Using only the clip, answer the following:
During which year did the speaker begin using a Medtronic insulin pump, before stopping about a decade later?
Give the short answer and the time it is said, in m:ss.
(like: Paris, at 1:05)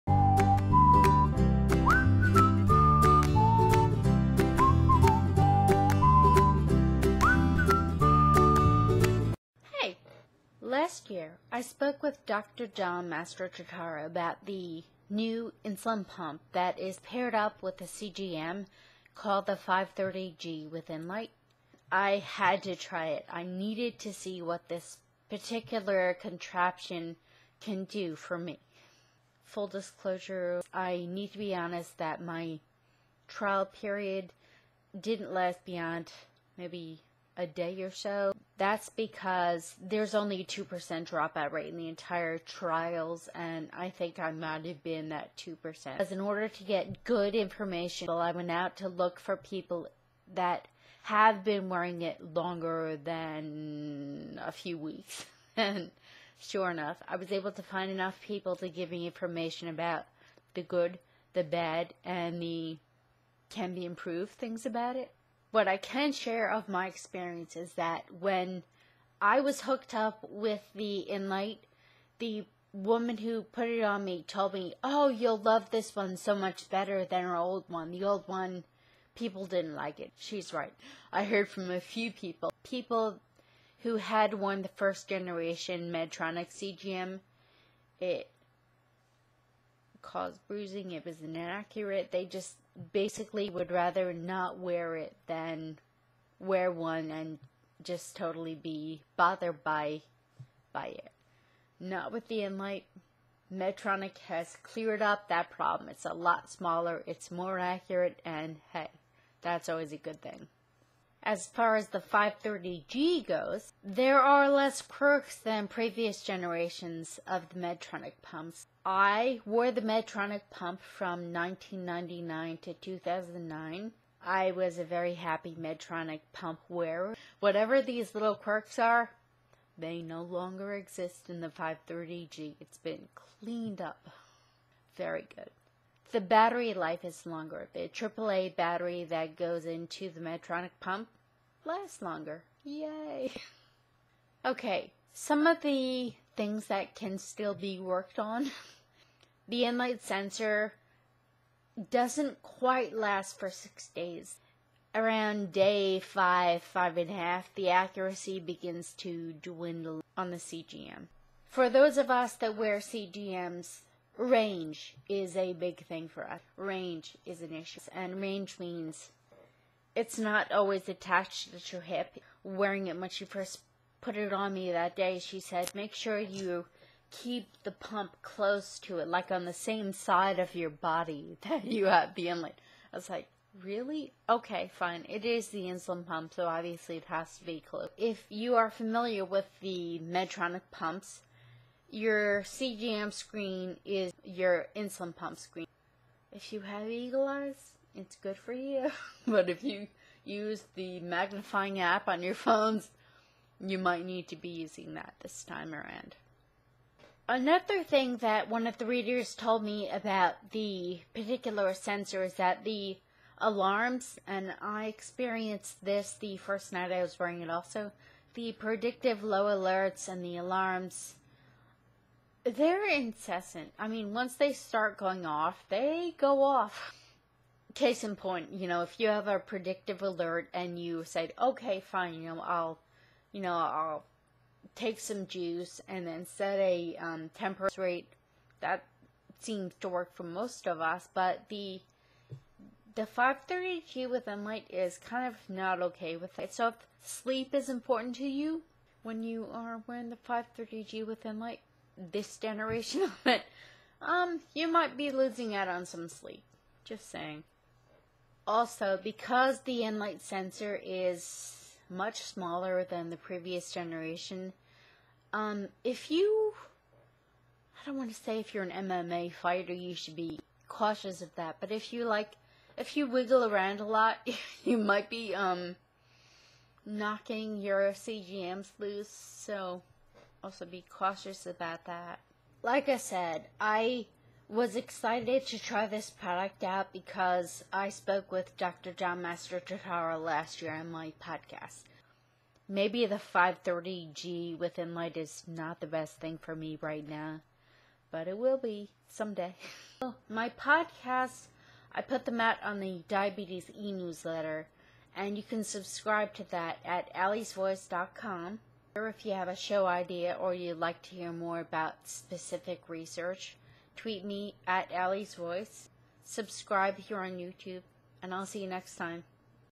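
1999, at 2:01.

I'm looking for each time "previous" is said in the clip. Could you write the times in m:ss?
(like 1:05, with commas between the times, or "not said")
1:55, 4:23.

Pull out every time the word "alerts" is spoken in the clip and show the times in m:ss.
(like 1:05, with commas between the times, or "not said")
3:39, 3:50.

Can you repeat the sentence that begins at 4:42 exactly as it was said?
Like I said, I was excited to try this product out because I spoke with Dr.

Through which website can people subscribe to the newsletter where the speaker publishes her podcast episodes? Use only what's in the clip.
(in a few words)
alliesvoice.com.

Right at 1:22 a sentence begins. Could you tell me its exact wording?
People who had won the first generation Medtronic CGM, it, cause bruising, it was inaccurate.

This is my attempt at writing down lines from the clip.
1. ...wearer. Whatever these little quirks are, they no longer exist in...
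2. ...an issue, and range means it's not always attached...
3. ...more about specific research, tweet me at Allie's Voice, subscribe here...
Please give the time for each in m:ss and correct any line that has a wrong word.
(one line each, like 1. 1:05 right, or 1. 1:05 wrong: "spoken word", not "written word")
1. 2:06 right
2. 2:47 right
3. 5:11 right.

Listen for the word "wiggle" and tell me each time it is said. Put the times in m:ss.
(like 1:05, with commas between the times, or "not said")
4:33.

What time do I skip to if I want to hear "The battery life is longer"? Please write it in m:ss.
2:16.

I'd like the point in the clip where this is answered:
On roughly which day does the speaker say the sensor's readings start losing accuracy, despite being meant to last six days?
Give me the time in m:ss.
2:35.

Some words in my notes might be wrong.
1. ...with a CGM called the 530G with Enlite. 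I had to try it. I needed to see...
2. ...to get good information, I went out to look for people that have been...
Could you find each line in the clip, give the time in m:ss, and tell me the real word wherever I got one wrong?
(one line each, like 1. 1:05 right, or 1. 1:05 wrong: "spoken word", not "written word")
1. 0:17 right
2. 0:46 right.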